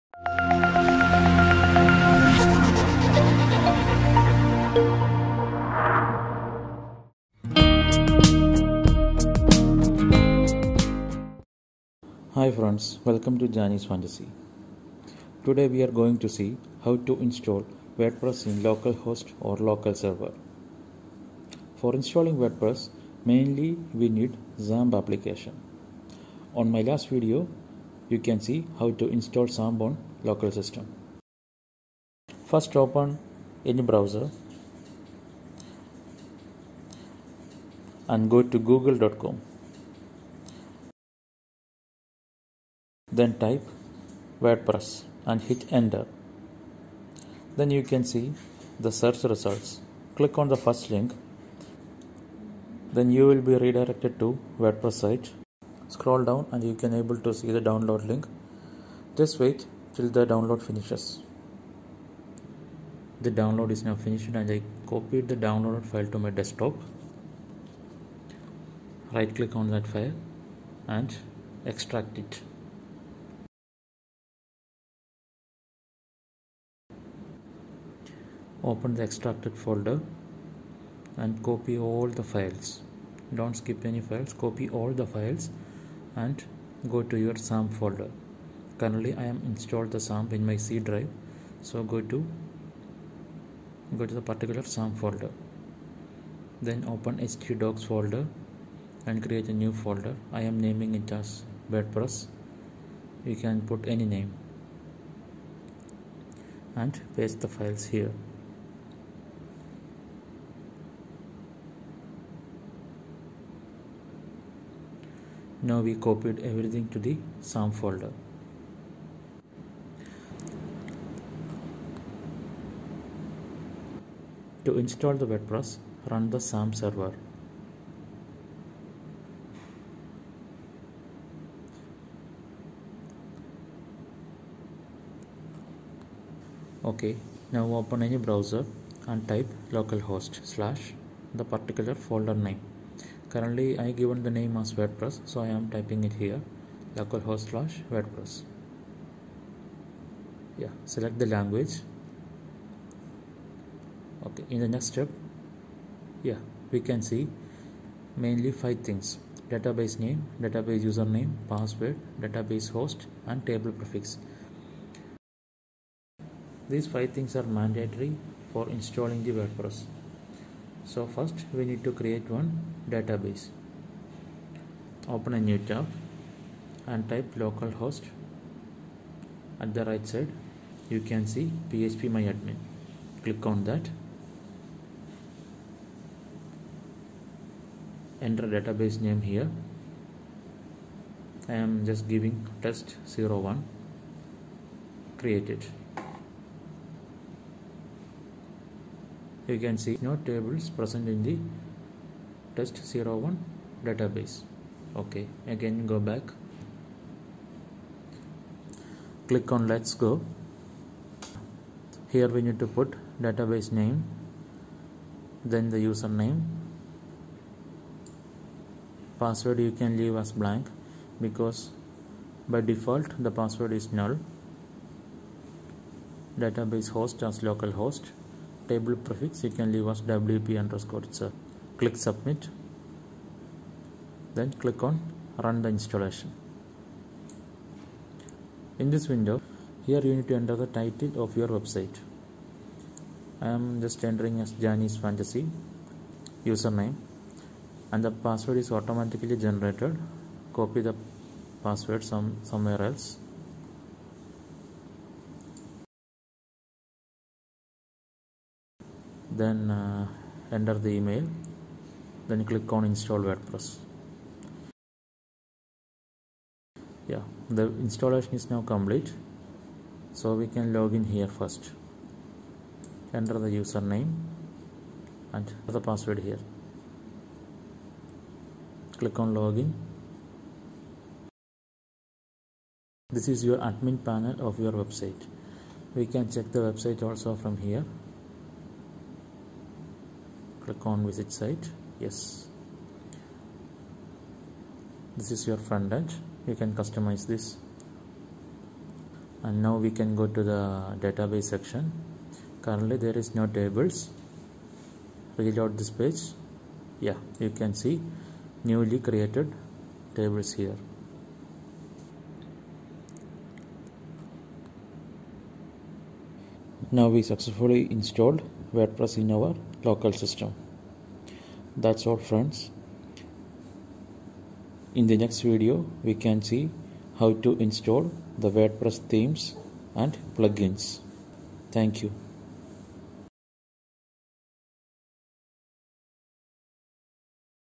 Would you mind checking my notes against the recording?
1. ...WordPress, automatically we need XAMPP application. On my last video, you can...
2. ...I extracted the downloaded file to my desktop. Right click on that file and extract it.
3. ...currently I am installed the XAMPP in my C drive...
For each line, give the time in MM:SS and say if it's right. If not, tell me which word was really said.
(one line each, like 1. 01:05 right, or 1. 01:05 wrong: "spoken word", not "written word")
1. 00:22 wrong: "mainly", not "automatically"
2. 01:04 wrong: "copied", not "extracted"
3. 01:28 right.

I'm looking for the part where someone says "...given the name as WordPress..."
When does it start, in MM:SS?
02:23.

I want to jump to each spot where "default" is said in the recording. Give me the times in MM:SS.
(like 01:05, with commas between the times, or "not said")
03:42.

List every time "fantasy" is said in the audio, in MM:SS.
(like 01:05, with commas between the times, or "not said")
00:13, 04:05.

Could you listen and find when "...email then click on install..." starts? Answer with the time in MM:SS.
04:20.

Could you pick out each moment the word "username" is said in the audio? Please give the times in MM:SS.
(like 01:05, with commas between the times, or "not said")
02:40, 03:35, 04:06, 04:33.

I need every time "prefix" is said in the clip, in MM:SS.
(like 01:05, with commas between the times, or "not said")
02:43, 03:49.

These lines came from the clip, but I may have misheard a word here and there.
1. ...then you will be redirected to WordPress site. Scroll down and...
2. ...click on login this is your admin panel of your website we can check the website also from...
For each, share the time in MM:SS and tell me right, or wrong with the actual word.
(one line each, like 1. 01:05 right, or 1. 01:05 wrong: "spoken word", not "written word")
1. 00:52 right
2. 04:38 right.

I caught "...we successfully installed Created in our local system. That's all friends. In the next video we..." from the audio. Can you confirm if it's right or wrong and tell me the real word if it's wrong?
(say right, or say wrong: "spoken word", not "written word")
wrong: "WordPress", not "Created".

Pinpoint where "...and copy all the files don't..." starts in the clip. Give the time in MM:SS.
01:21.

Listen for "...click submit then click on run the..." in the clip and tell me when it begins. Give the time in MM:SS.
03:51.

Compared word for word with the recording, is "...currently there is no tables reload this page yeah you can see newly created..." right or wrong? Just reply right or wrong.
right.